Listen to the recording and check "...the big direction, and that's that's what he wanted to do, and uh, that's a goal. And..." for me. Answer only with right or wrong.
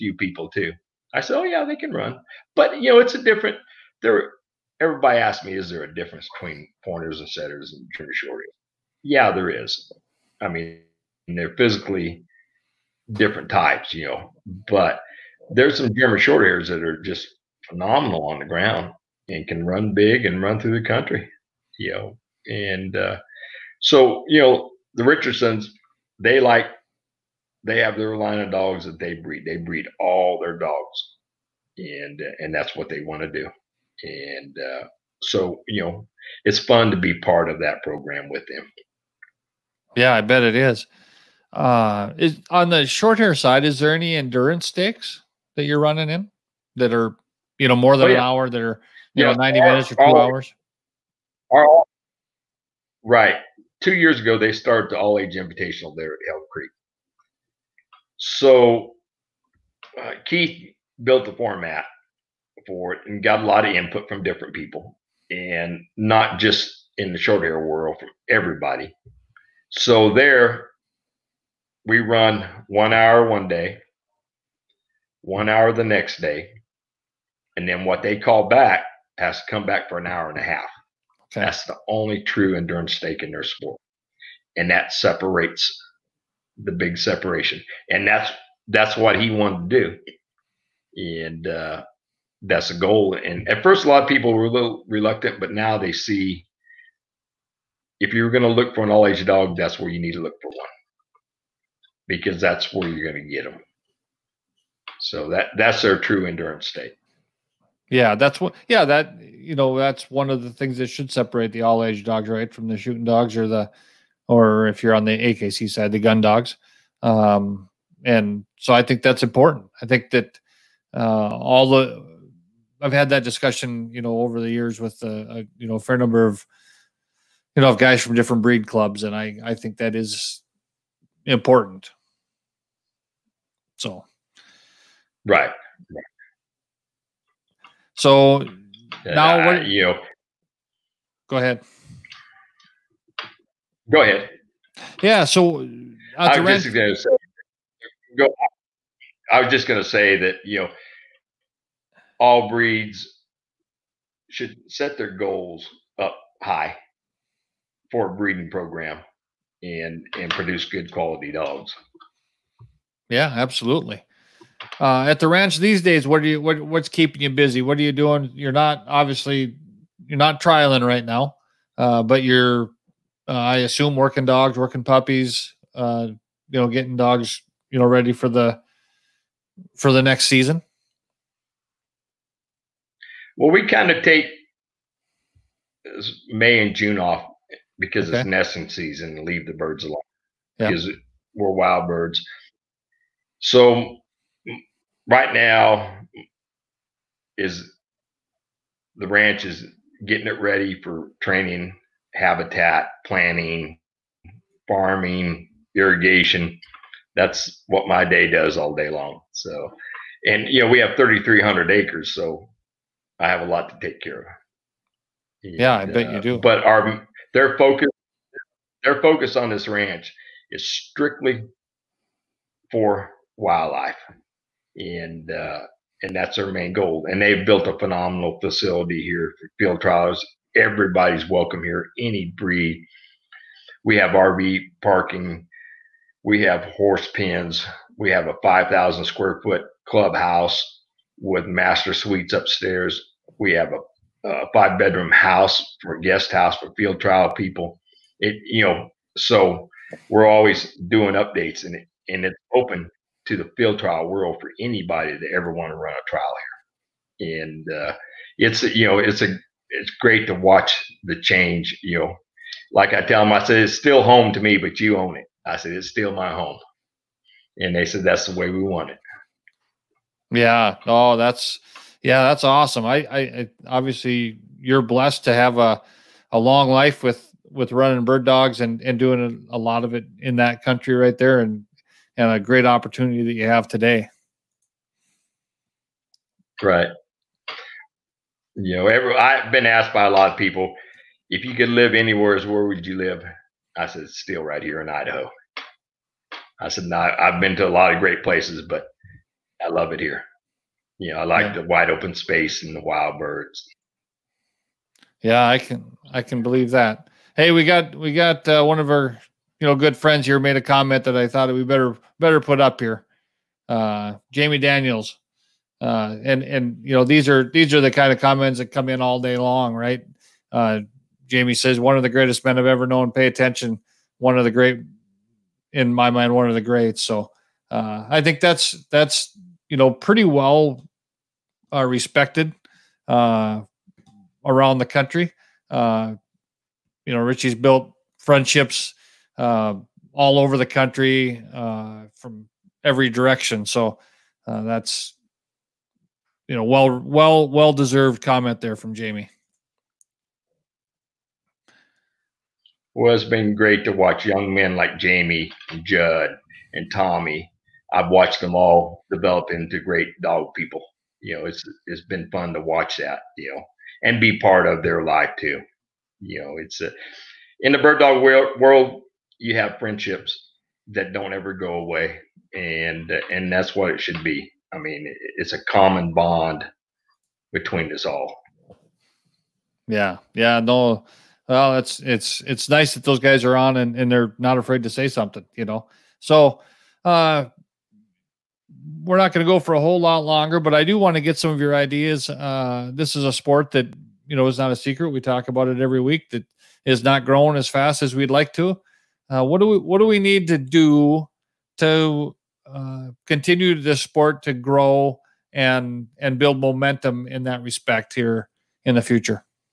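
wrong.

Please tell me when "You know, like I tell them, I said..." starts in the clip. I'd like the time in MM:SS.
04:21.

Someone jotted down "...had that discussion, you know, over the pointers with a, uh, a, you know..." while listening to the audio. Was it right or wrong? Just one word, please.
wrong.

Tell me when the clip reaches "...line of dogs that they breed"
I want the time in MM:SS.
00:28.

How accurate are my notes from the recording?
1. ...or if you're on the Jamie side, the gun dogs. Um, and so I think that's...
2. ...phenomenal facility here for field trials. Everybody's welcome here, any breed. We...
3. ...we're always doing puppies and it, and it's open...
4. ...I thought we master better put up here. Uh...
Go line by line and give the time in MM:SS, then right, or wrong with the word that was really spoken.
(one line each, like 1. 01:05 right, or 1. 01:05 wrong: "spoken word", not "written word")
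1. 01:54 wrong: "AKC", not "Jamie"
2. 03:47 right
3. 04:10 wrong: "updates", not "puppies"
4. 05:11 wrong: "better", not "master".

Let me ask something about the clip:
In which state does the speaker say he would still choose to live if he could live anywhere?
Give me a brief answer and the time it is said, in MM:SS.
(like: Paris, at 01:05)
Idaho, at 04:54.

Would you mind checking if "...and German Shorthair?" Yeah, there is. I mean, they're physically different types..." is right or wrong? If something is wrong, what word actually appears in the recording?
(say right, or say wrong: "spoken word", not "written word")
right.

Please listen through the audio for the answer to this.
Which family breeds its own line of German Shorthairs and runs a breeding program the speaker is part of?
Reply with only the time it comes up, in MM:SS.
00:24.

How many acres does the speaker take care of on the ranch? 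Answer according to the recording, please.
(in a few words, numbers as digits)
3,300.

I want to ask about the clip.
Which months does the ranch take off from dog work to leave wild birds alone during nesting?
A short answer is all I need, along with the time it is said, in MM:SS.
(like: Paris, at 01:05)
May and June, at 03:06.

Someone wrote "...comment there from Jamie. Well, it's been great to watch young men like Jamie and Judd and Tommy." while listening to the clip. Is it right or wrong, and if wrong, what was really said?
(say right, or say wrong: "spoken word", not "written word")
right.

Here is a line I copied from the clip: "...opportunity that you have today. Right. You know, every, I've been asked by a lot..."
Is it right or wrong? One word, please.
right.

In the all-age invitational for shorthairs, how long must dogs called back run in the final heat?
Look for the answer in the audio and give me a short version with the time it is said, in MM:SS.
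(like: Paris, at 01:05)
An hour and a half, at 01:19.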